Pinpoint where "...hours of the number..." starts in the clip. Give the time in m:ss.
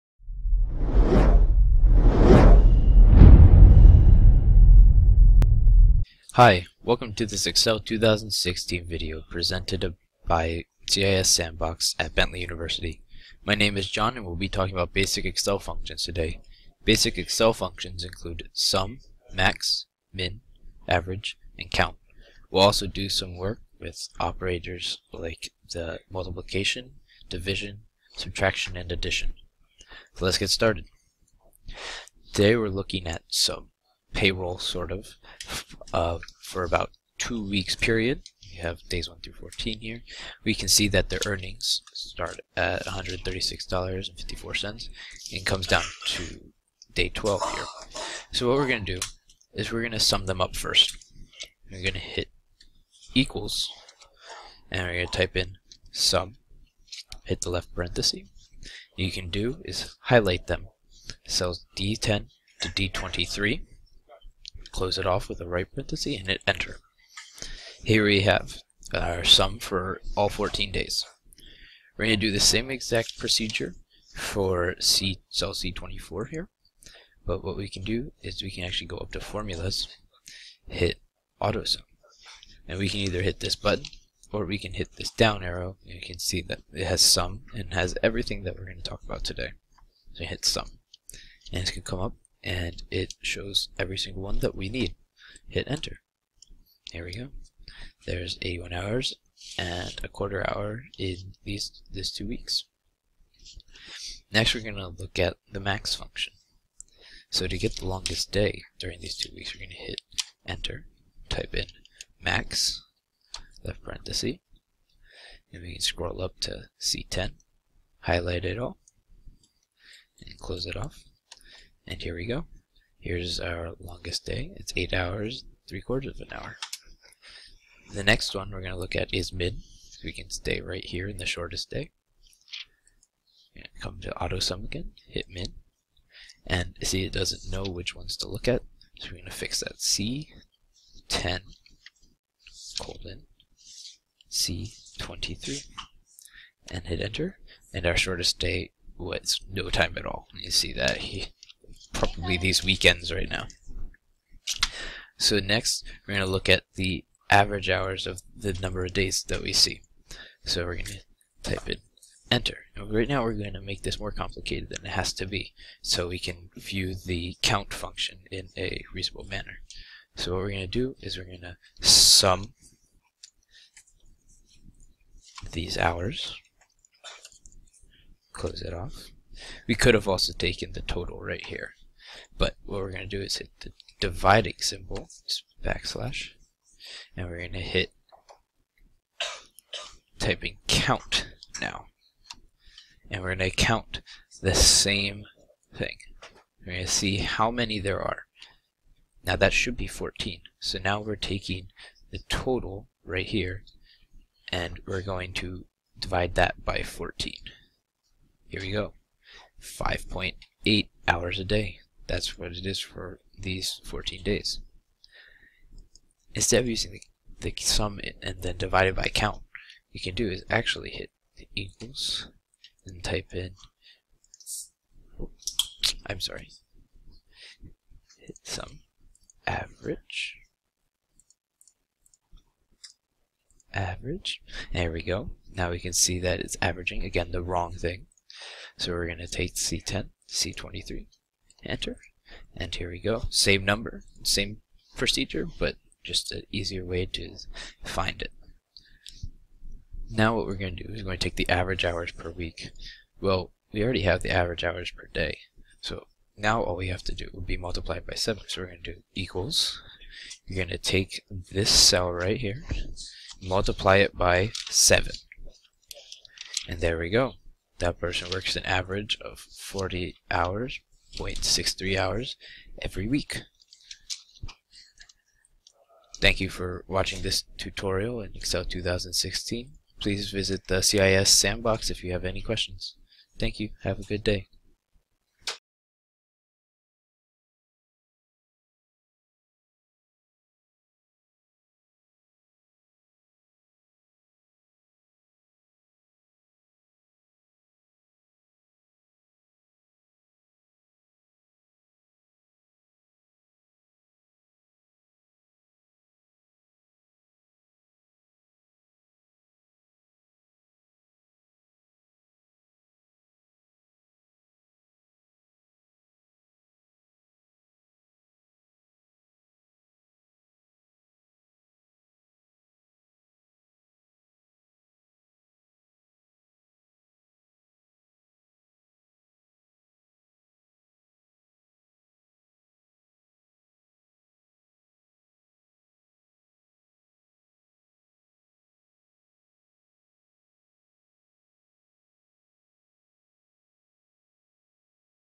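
2:37.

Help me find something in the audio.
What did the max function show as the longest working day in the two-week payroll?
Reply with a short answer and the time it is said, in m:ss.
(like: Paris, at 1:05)
8 hours 3 quarters, at 2:04.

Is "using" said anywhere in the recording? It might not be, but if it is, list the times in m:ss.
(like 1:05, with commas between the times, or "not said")
3:36.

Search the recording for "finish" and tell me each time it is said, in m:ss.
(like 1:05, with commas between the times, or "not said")
not said.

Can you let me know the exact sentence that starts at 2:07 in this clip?
The next one we're going to look at is min.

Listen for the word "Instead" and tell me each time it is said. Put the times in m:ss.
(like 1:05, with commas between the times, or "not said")
3:36.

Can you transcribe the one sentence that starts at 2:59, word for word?
We could have also taken the total right here.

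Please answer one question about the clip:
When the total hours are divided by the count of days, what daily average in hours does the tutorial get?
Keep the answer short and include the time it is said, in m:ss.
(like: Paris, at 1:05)
5.8 hours, at 3:29.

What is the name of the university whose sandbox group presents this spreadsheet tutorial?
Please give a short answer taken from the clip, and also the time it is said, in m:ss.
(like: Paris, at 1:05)
Bentley University, at 0:12.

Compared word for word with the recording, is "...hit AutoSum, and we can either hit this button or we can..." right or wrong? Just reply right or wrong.
right.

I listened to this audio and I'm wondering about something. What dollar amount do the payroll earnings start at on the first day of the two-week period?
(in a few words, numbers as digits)
$136.54.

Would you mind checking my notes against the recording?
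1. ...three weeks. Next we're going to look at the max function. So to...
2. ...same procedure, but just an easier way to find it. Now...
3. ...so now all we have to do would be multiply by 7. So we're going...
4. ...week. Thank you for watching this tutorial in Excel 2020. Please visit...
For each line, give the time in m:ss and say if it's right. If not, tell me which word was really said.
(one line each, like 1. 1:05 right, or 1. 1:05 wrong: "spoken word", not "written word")
1. 1:42 wrong: "two", not "three"
2. 4:04 right
3. 4:15 right
4. 4:33 wrong: "2016", not "2020".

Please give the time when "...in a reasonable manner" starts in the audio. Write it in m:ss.
2:48.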